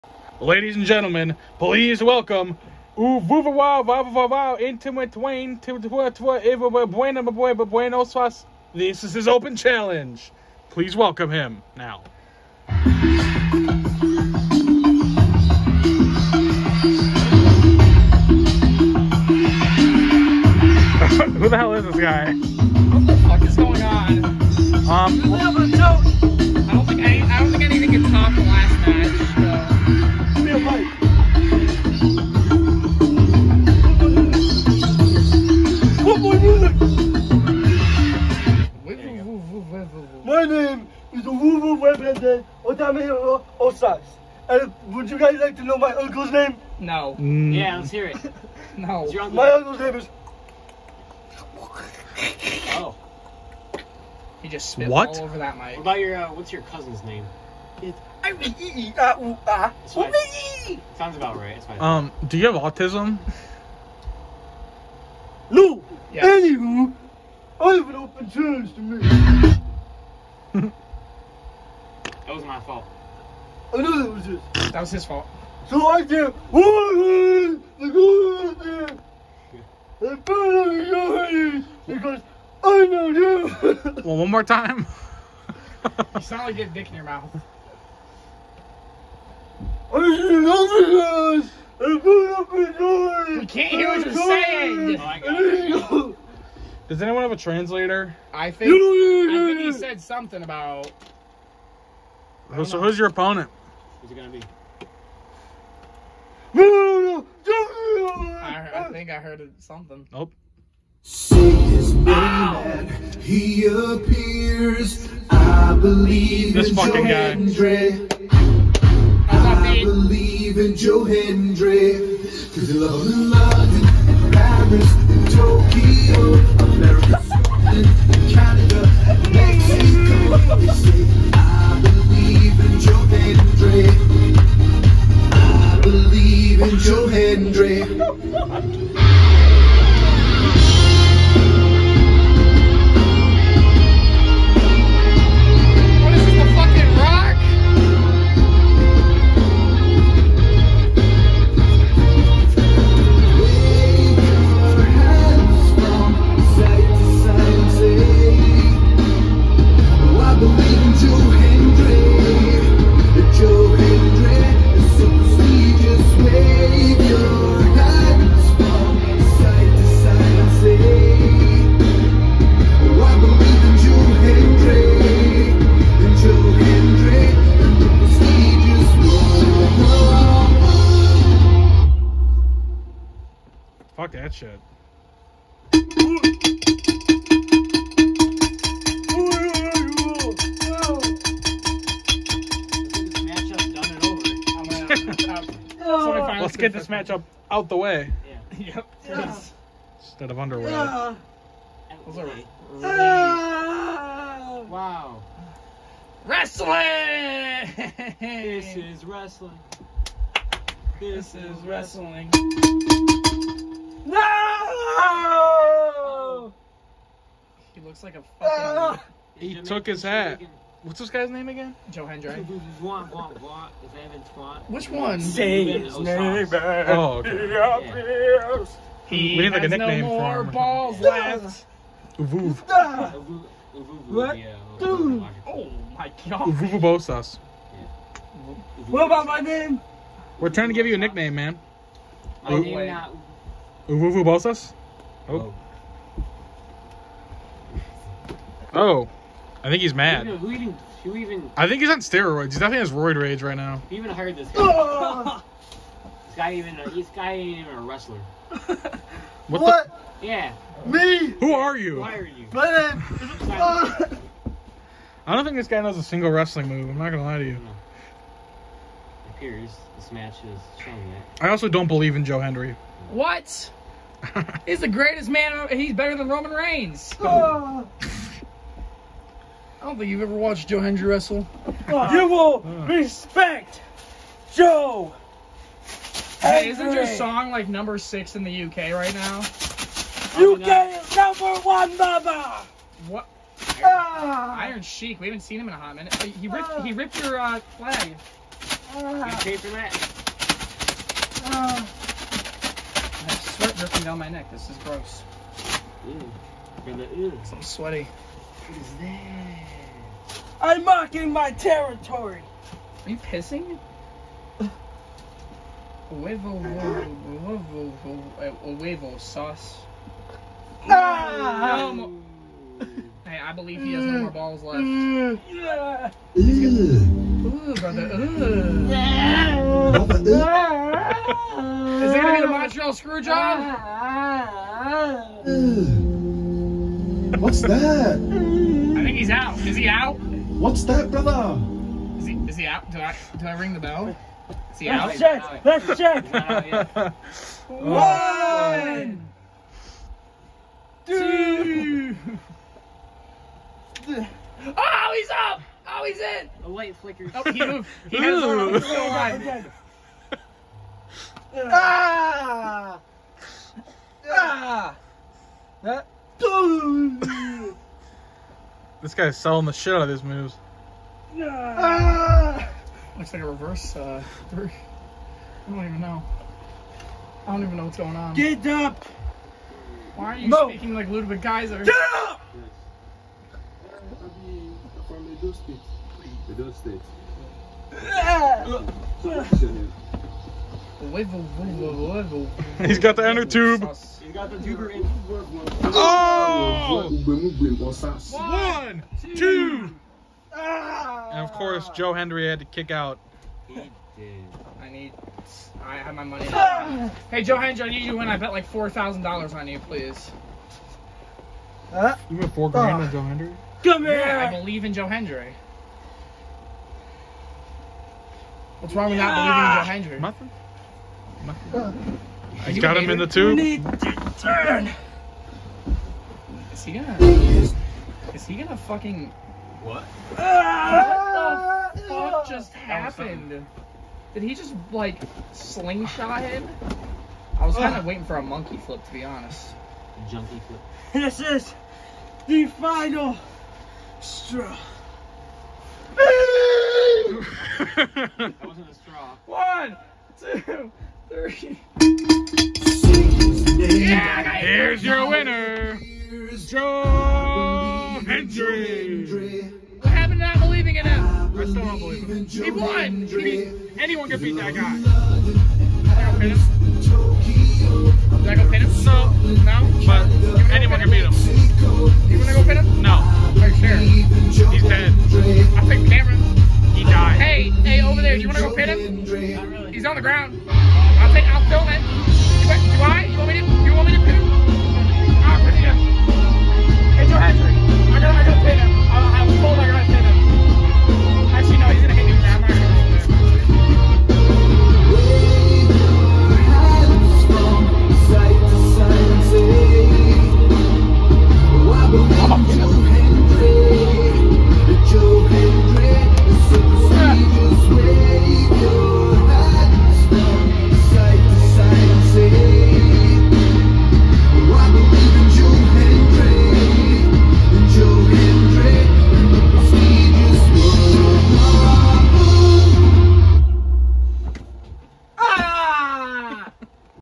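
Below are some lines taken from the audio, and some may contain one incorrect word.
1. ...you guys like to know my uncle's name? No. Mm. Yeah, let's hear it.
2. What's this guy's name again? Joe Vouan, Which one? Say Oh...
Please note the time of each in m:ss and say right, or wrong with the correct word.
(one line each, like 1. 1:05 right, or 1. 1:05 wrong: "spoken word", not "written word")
1. 0:45 right
2. 3:40 right.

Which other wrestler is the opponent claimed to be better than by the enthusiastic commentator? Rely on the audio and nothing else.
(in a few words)
Roman Reigns.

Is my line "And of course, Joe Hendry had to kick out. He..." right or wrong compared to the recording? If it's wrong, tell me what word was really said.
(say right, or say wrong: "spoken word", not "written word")
right.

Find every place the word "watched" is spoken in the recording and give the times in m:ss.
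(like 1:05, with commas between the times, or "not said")
4:40.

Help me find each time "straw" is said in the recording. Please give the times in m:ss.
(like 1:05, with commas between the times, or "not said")
7:24, 7:28.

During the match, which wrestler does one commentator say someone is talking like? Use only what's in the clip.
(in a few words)
Ludwig Kaiser.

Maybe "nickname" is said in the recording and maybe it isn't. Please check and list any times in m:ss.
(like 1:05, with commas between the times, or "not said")
3:49, 4:00.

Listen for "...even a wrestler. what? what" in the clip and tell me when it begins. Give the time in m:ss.
4:17.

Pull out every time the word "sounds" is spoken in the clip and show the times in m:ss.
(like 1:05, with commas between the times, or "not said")
1:00, 1:26.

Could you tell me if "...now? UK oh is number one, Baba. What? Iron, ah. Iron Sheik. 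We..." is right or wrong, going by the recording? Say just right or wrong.
right.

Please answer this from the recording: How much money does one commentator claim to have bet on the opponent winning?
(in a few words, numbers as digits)
$4,000.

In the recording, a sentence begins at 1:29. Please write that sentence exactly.
I We can't hear what you're saying.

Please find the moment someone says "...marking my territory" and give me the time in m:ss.
5:10.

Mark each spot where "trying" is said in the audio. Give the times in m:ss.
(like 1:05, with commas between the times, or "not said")
4:00.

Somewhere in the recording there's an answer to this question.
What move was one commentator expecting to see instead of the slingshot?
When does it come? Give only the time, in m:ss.
7:18.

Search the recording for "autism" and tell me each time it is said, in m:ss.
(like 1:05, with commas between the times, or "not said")
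1:02.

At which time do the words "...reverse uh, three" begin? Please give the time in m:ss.
6:13.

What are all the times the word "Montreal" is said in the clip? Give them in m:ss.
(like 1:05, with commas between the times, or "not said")
5:32.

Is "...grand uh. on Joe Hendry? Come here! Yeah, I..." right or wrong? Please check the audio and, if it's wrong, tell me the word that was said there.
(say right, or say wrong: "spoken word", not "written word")
right.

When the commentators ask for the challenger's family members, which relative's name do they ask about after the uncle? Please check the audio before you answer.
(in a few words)
Cousin.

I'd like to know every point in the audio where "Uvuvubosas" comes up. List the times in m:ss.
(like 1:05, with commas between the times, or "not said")
3:56, 4:03.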